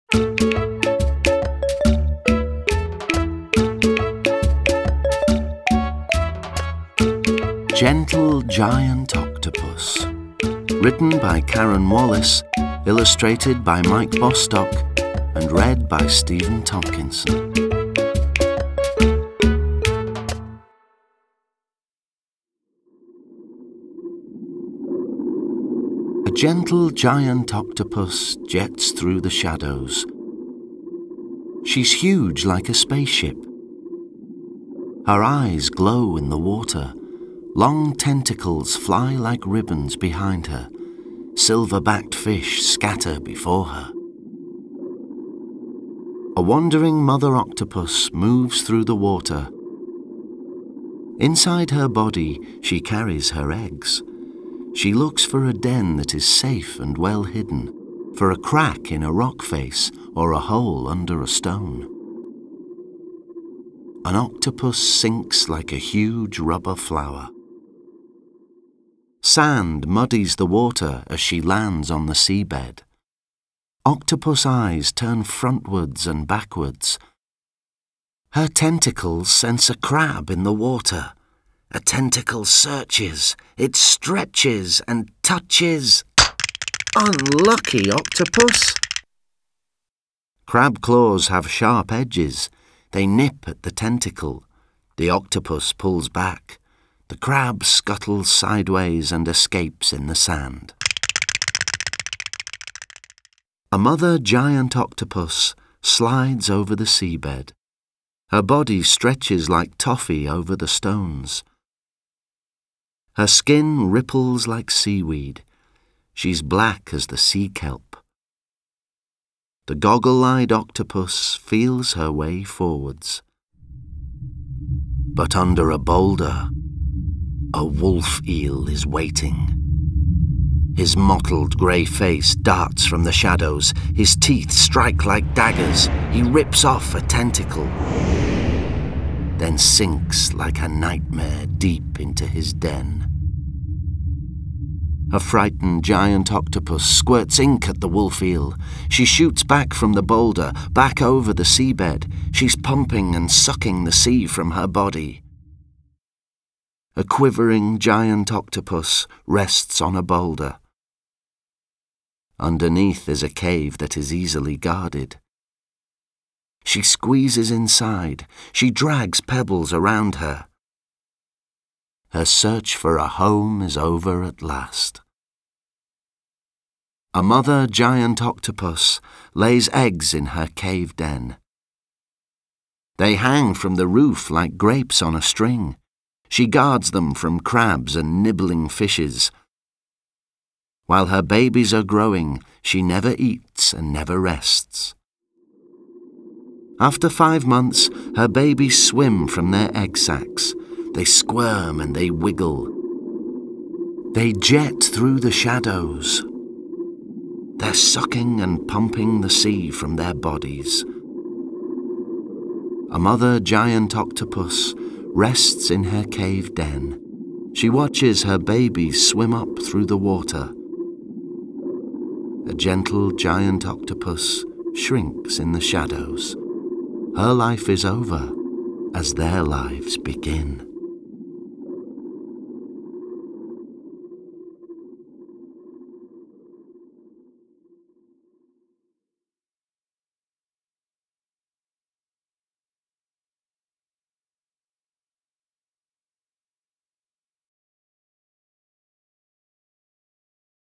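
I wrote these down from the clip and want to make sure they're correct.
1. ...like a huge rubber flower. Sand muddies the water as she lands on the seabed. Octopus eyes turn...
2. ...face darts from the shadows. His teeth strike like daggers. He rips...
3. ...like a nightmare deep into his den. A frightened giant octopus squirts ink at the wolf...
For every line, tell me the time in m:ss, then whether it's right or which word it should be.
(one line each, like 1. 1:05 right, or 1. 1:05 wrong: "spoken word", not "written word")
1. 1:05 right
2. 2:11 right
3. 2:20 right.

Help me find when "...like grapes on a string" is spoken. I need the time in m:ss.
3:04.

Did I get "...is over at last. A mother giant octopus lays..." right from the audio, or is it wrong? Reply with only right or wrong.
right.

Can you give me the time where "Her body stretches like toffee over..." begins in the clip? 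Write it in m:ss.
1:48.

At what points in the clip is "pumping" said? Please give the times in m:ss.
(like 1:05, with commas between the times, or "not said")
2:32, 3:28.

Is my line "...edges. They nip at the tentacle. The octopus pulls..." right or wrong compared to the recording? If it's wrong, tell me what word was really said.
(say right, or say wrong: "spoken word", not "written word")
right.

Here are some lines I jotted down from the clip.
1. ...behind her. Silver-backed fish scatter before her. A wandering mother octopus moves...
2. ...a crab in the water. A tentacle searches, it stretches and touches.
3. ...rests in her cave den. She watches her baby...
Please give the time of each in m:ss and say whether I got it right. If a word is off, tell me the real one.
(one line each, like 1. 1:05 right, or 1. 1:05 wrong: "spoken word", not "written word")
1. 0:39 right
2. 1:19 right
3. 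3:35 right.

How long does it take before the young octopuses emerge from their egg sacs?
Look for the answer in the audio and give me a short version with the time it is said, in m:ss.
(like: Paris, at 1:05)
5 months, at 3:17.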